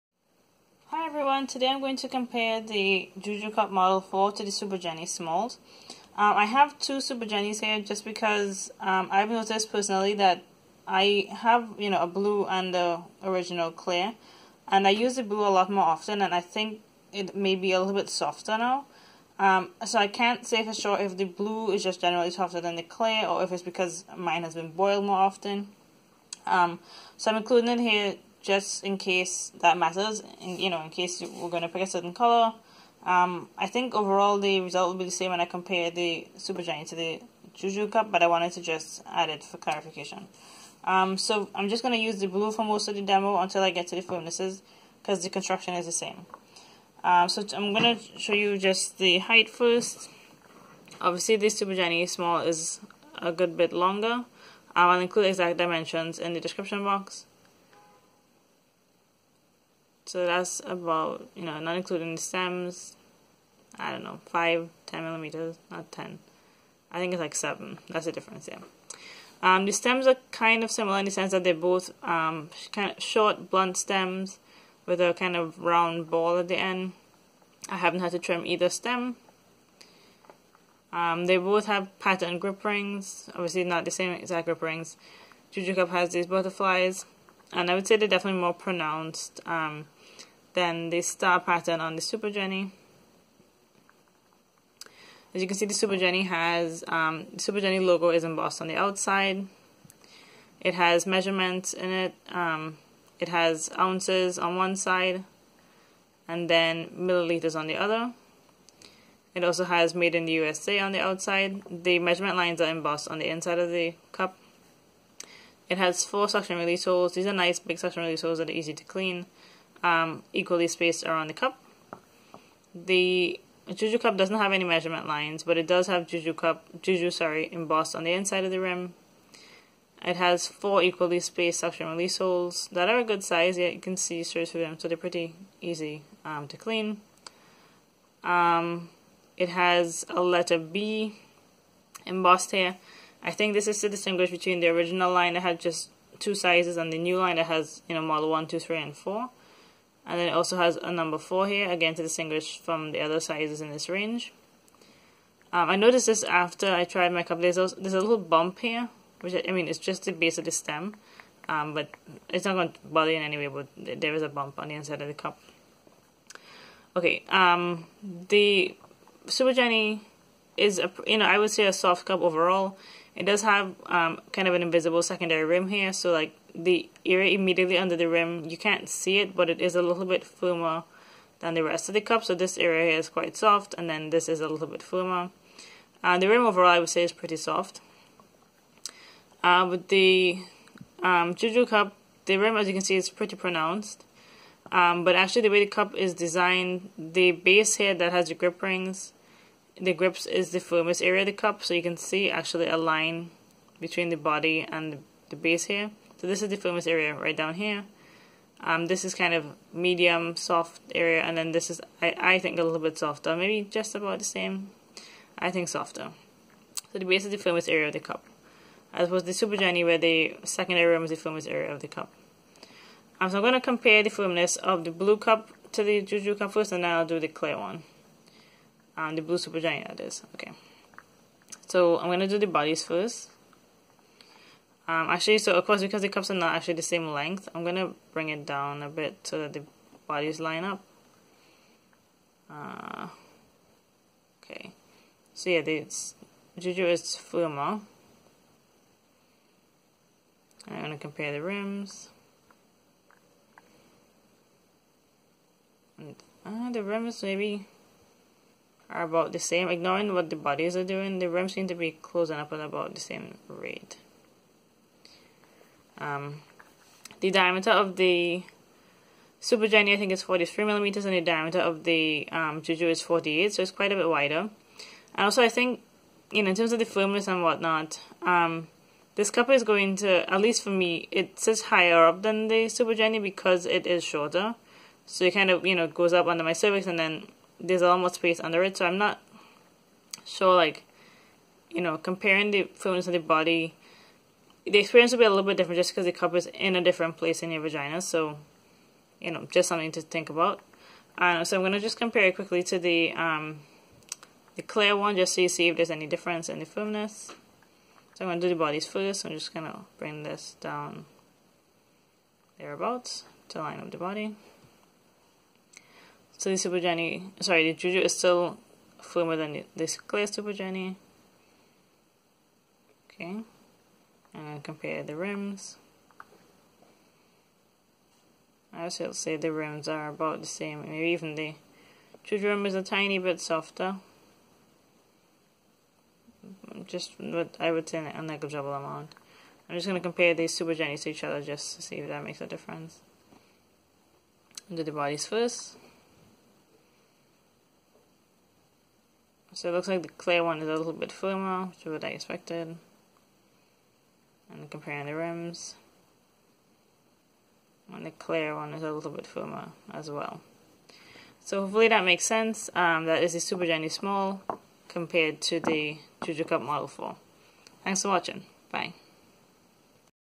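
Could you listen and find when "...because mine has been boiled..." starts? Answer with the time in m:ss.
0:23.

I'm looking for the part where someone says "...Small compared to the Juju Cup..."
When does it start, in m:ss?
6:03.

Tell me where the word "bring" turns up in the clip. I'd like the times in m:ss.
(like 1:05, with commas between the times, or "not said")
3:58, 5:09.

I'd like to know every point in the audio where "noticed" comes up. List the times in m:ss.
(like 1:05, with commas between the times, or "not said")
0:09, 2:35.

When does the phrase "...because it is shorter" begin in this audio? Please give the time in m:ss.
4:43.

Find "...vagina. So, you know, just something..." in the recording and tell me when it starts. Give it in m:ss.
4:57.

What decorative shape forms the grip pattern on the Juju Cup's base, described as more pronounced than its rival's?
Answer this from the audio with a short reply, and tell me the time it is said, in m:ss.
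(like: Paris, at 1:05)
Butterflies, at 1:26.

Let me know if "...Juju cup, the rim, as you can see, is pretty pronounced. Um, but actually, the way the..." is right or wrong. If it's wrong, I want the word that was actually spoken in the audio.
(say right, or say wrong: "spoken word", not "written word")
right.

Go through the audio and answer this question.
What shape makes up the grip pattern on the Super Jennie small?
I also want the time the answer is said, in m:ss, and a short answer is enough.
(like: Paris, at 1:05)
Star, at 1:31.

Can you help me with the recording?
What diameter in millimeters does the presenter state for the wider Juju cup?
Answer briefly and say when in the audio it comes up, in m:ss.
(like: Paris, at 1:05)
48, at 4:33.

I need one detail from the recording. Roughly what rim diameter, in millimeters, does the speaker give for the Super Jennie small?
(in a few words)
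43.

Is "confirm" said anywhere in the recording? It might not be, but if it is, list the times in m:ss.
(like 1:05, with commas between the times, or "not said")
not said.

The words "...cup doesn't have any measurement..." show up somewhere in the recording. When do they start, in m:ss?
2:03.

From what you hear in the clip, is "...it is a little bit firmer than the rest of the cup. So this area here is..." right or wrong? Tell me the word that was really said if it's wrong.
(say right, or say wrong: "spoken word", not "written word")
right.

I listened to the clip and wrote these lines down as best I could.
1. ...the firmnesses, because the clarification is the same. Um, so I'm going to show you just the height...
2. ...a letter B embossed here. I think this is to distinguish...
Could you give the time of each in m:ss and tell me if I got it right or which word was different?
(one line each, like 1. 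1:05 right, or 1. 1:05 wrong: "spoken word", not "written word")
1. 0:43 wrong: "construction", not "clarification"
2. 2:20 right.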